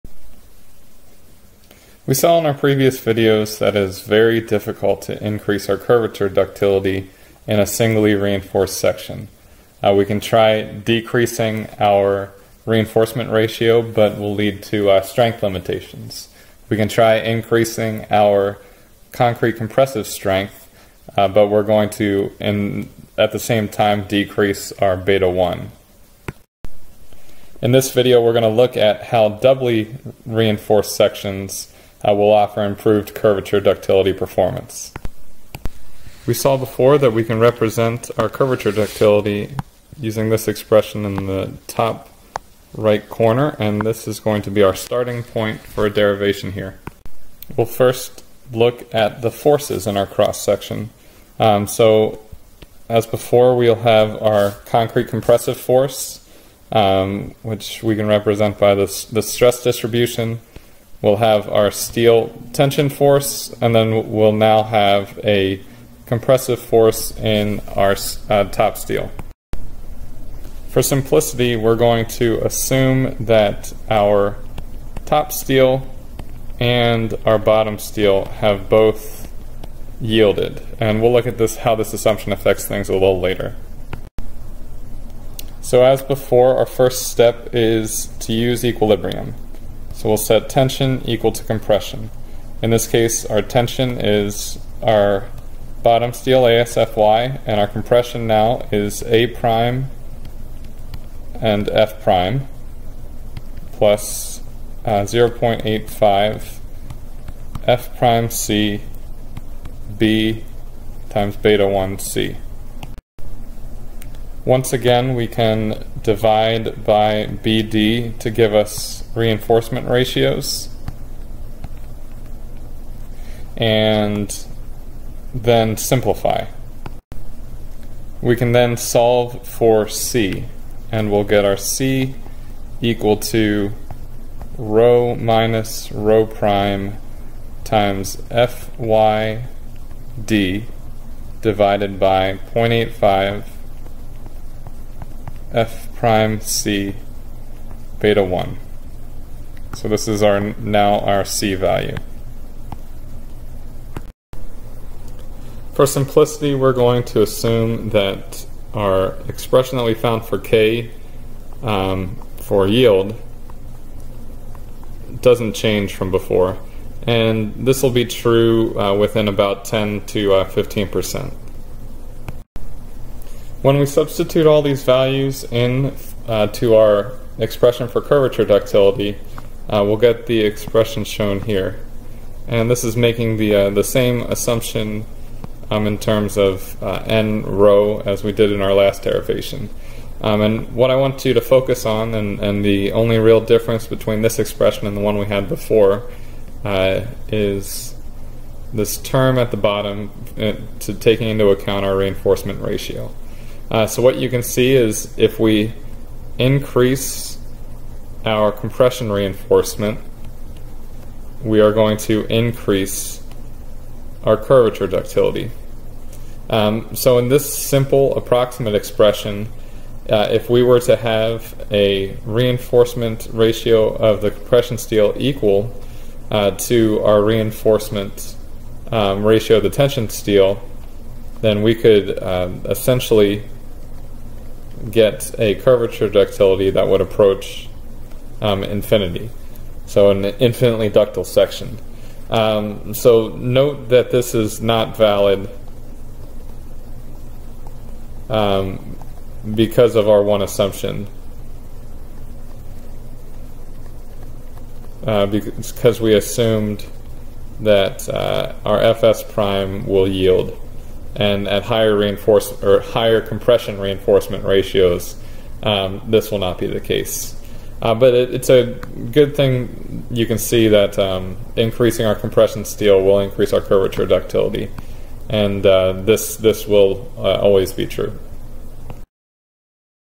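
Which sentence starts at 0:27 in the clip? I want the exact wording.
In this video, we're going to look at how doubly reinforced sections uh, will offer improved curvature ductility performance.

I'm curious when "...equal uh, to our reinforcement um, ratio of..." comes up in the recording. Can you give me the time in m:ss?
3:45.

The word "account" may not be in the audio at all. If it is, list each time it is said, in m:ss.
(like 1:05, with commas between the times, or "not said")
3:21.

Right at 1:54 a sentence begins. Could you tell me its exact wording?
Once again, we can divide by BD to give us reinforcement ratios.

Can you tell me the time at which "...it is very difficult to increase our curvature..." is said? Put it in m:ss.
0:03.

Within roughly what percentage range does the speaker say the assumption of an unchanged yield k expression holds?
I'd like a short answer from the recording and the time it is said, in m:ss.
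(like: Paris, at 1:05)
10 to 15%, at 2:49.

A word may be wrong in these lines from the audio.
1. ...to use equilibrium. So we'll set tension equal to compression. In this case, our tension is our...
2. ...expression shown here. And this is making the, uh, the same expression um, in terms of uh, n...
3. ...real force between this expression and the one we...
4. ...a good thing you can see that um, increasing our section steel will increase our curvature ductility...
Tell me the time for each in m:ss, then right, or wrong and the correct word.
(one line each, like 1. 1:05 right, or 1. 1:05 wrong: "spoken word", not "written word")
1. 1:28 right
2. 3:00 wrong: "assumption", not "expression"
3. 3:13 wrong: "difference", not "force"
4. 4:28 wrong: "compression", not "section".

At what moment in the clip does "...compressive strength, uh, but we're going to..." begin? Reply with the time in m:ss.
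0:19.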